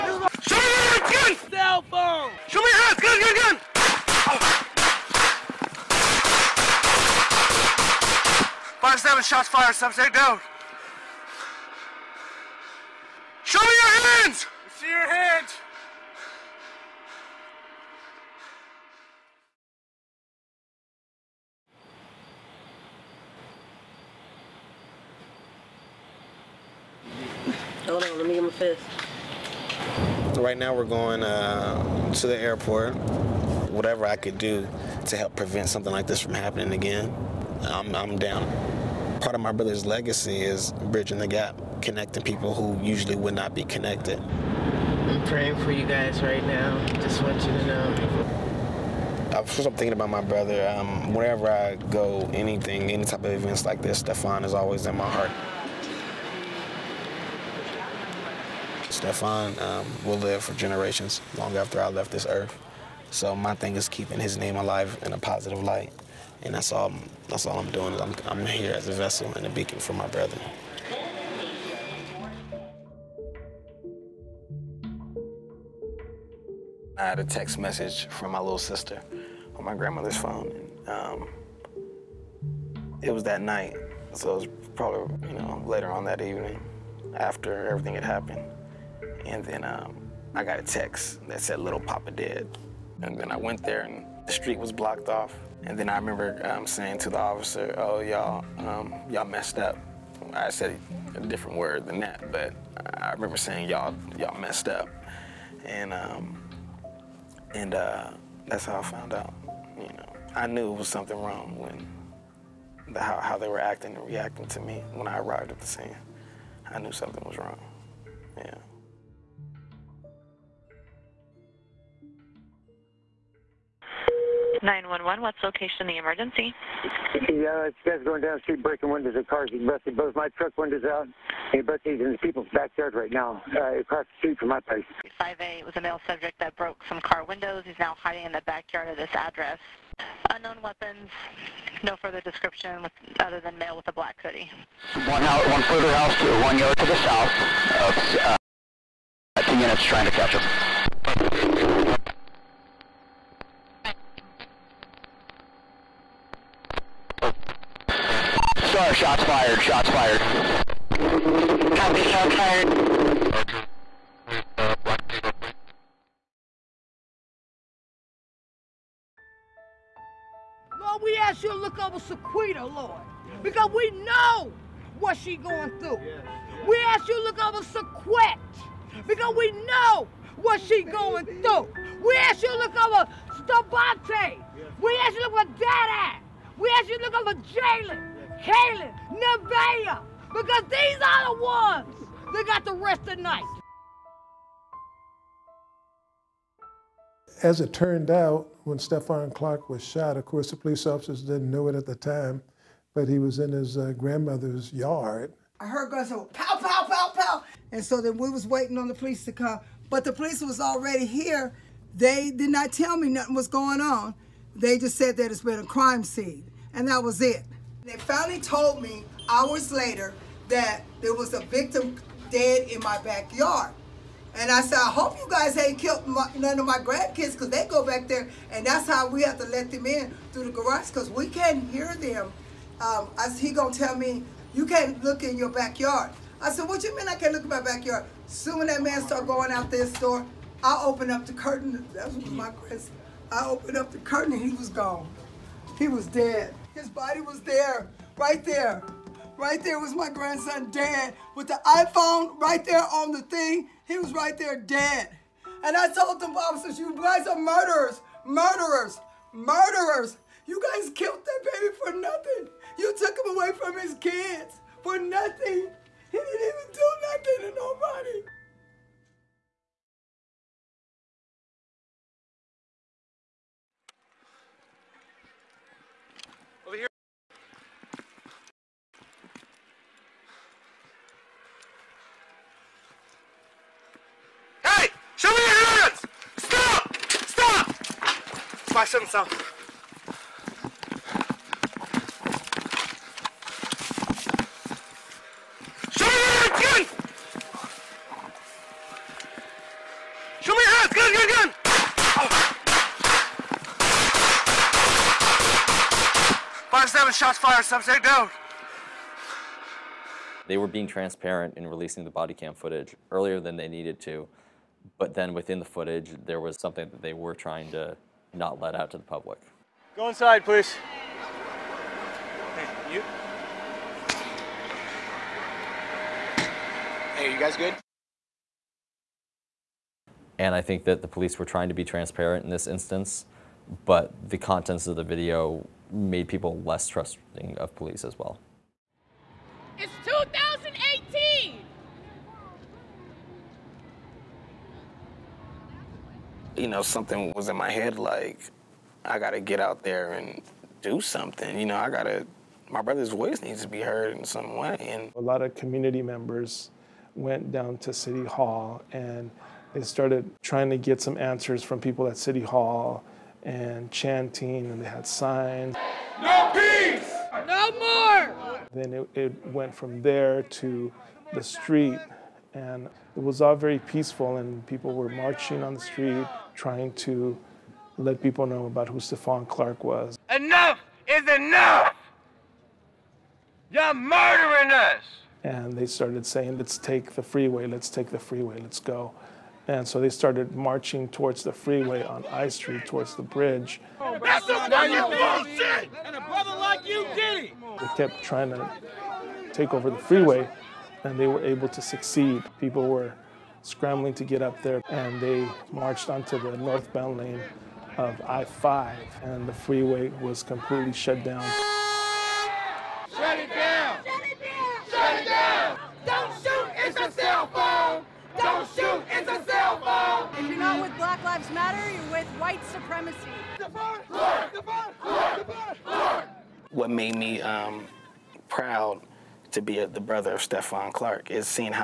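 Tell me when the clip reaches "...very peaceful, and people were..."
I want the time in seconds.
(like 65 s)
373 s.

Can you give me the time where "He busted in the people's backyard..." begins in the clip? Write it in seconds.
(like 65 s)
131 s.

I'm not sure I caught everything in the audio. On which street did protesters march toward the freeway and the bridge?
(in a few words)
I Street.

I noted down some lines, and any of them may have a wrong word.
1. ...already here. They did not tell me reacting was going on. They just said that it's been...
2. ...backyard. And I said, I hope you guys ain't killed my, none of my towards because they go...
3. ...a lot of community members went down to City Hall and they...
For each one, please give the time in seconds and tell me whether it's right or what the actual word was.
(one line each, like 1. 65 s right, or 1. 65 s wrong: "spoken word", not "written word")
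1. 210 s wrong: "nothing", not "reacting"
2. 223 s wrong: "grandkids", not "towards"
3. 355 s right.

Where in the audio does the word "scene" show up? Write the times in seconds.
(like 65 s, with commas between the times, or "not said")
115 s, 216 s.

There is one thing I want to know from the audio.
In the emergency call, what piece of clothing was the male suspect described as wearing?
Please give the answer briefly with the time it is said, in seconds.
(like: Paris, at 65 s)
Black hoodie, at 143 s.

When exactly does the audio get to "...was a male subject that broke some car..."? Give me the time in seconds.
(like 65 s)
135 s.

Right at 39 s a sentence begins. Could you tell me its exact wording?
Part of my brother's legacy is bridging the gap, connecting people who usually would not be connected.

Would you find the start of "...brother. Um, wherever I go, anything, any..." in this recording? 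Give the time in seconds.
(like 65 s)
50 s.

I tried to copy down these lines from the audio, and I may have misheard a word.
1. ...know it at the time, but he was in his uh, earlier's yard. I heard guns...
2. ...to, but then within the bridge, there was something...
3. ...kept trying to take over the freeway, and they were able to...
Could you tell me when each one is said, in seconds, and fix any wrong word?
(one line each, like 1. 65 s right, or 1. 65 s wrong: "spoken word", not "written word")
1. 201 s wrong: "grandmother", not "earlier"
2. 314 s wrong: "footage", not "bridge"
3. 397 s right.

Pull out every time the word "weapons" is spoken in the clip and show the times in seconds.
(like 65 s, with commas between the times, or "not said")
140 s.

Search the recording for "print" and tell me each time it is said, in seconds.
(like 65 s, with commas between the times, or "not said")
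not said.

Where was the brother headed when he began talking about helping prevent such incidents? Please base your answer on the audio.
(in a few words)
The airport.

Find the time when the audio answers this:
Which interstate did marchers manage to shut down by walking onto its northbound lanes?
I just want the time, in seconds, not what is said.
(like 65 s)
408 s.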